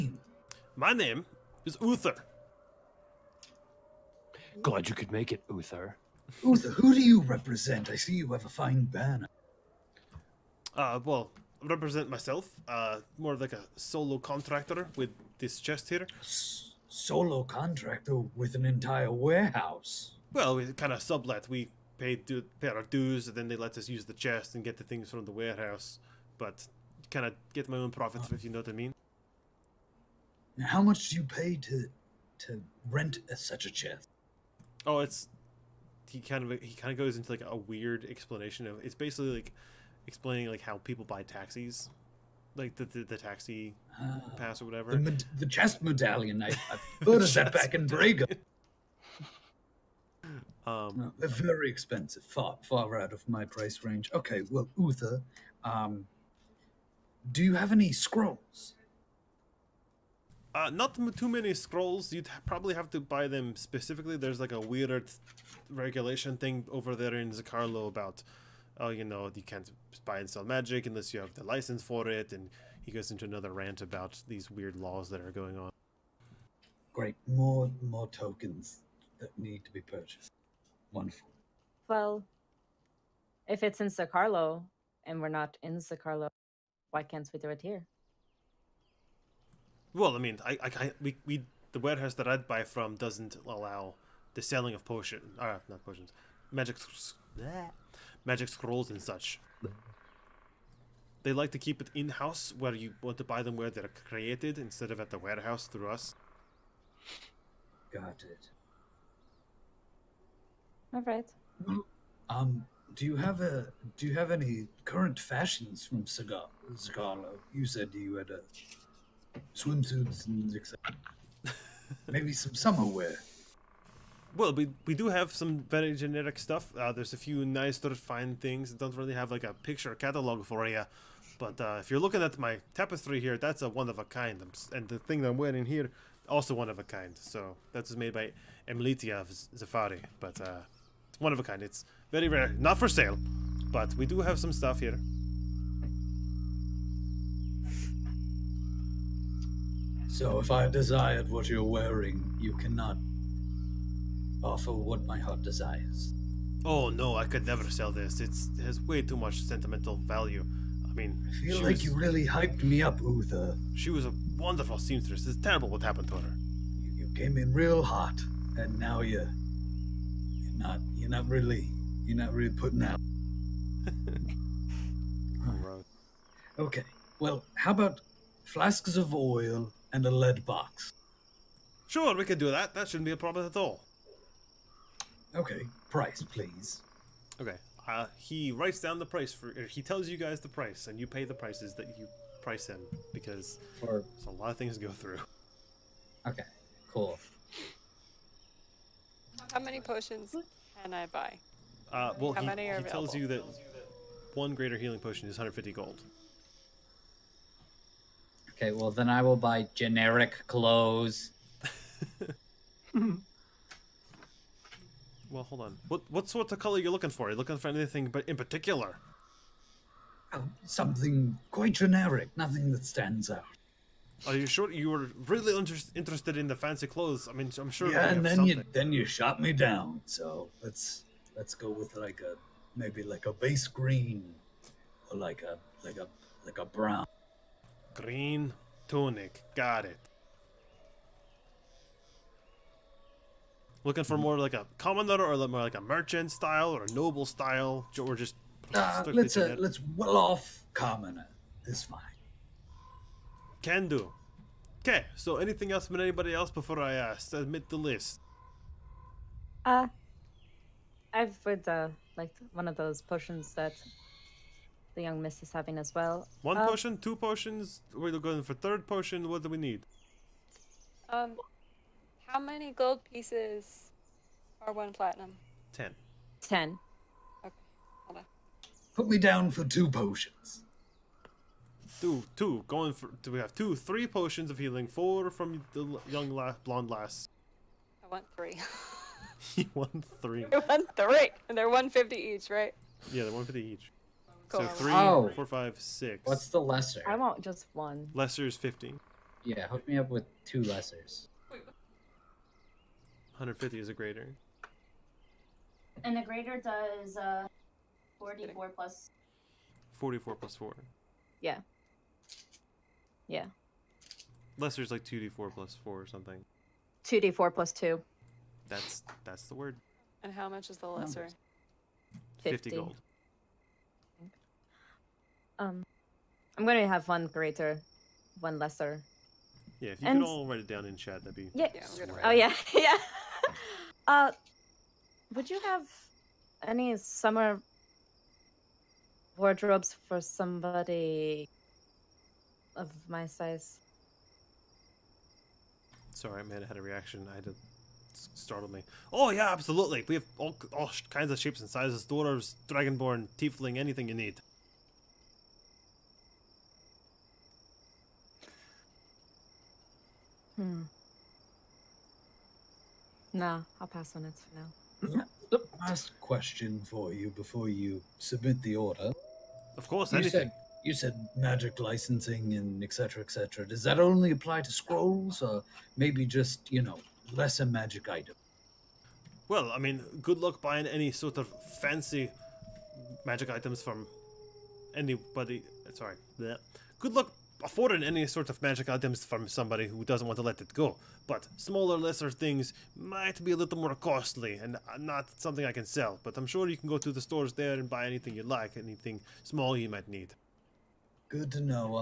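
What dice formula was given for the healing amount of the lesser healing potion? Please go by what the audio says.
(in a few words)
2d4 plus 2.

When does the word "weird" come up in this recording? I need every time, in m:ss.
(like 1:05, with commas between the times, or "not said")
0:37, 1:04, 1:14.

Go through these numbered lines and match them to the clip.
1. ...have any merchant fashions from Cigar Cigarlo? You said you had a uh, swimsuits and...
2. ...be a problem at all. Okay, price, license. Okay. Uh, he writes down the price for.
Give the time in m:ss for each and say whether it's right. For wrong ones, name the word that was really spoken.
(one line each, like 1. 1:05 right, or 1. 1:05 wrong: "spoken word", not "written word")
1. 1:54 wrong: "current", not "merchant"
2. 3:03 wrong: "please", not "license".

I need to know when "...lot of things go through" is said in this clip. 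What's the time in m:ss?
3:14.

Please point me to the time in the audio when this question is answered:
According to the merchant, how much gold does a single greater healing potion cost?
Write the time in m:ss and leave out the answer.
3:25.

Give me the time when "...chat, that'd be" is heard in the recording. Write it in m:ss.
5:30.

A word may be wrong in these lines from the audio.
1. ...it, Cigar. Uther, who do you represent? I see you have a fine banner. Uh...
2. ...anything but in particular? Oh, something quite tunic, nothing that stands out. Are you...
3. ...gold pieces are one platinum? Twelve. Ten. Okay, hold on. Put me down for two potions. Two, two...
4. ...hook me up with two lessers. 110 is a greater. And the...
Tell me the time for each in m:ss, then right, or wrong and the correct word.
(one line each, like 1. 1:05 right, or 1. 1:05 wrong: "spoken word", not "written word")
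1. 0:05 wrong: "Uther", not "Cigar"
2. 3:37 wrong: "generic", not "tunic"
3. 4:32 wrong: "Ten", not "Twelve"
4. 4:59 wrong: "150", not "110".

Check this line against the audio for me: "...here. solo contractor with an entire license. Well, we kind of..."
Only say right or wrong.
wrong.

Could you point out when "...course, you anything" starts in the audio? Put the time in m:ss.
6:09.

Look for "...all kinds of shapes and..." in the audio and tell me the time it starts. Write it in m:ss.
5:50.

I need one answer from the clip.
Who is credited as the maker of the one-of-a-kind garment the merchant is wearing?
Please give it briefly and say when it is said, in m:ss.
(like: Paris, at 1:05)
Emilitia of Zafari, at 2:18.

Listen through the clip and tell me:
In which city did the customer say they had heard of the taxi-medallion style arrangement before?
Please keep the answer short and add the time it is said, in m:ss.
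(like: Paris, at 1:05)
Braga, at 0:47.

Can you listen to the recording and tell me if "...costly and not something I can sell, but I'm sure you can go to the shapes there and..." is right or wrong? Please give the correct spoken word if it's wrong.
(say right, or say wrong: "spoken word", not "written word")
wrong: "stores", not "shapes".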